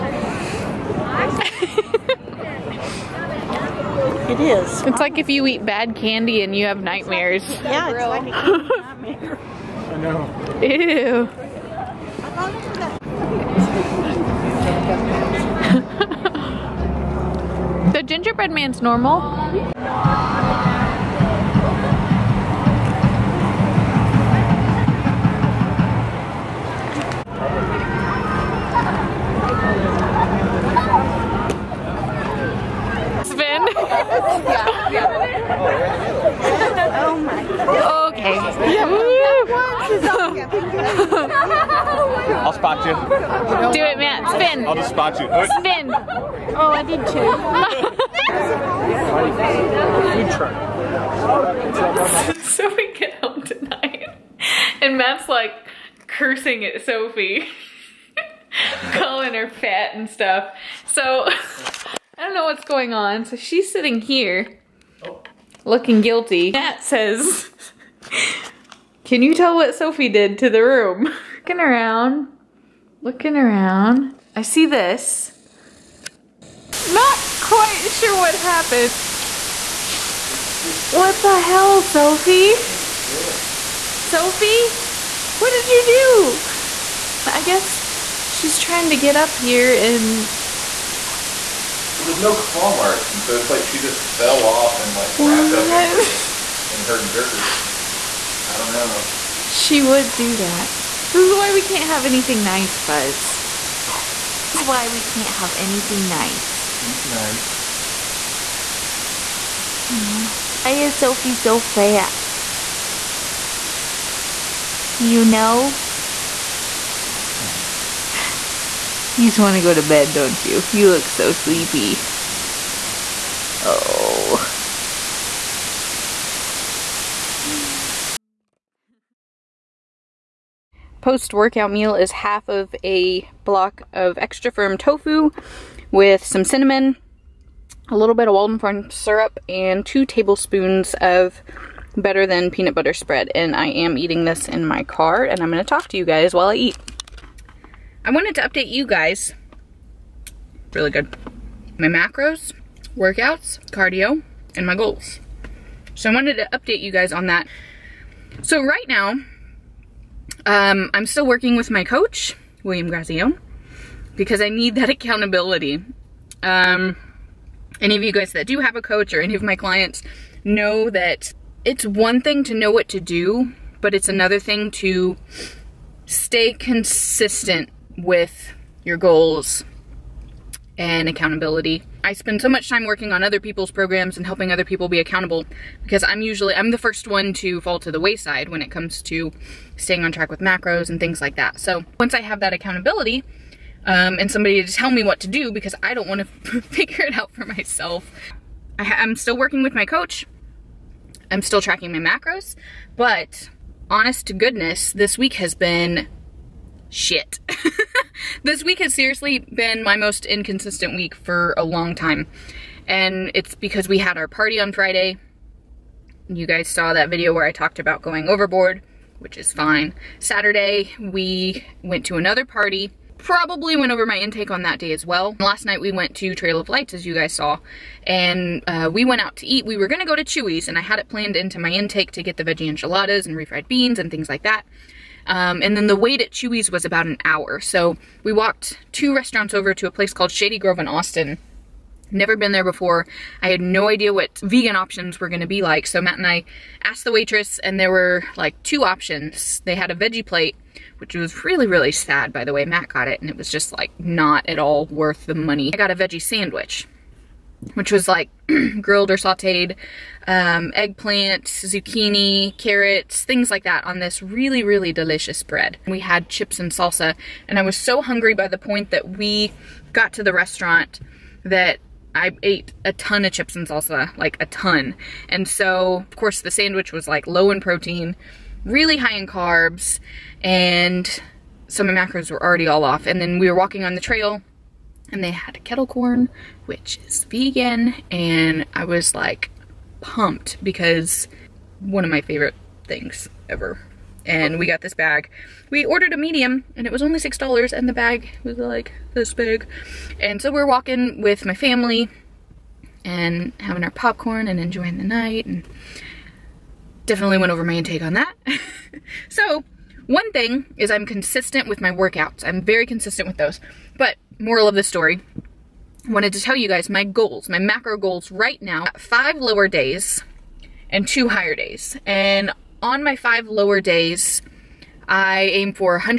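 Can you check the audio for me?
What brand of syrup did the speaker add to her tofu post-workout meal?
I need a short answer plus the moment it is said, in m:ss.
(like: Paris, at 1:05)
Walden Farm, at 2:18.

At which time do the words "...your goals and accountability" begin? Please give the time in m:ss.
2:58.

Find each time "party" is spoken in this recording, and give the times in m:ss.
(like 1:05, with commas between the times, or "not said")
3:34, 3:42.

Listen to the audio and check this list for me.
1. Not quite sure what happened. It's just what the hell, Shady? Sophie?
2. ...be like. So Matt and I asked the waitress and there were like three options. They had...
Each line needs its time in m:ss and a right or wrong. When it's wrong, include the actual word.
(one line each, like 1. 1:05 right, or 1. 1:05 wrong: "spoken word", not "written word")
1. 1:16 wrong: "Sophie", not "Shady"
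2. 4:05 wrong: "two", not "three".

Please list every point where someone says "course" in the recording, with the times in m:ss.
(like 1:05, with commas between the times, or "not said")
4:36.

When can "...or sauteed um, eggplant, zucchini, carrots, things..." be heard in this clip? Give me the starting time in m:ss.
4:19.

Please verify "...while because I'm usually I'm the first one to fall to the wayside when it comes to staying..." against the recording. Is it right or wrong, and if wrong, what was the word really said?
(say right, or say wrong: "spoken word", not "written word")
wrong: "accountable", not "while".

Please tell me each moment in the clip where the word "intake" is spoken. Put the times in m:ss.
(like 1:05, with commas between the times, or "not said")
3:44, 3:51, 5:07.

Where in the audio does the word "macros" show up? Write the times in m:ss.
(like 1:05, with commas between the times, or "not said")
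2:31, 3:10, 3:21, 4:41, 5:17.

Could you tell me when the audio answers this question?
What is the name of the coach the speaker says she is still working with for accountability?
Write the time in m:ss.
2:42.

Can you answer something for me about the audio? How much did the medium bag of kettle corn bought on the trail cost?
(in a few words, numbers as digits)
$6.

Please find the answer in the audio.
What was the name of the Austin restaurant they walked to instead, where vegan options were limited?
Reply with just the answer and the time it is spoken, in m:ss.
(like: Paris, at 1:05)
Shady Grove, at 4:00.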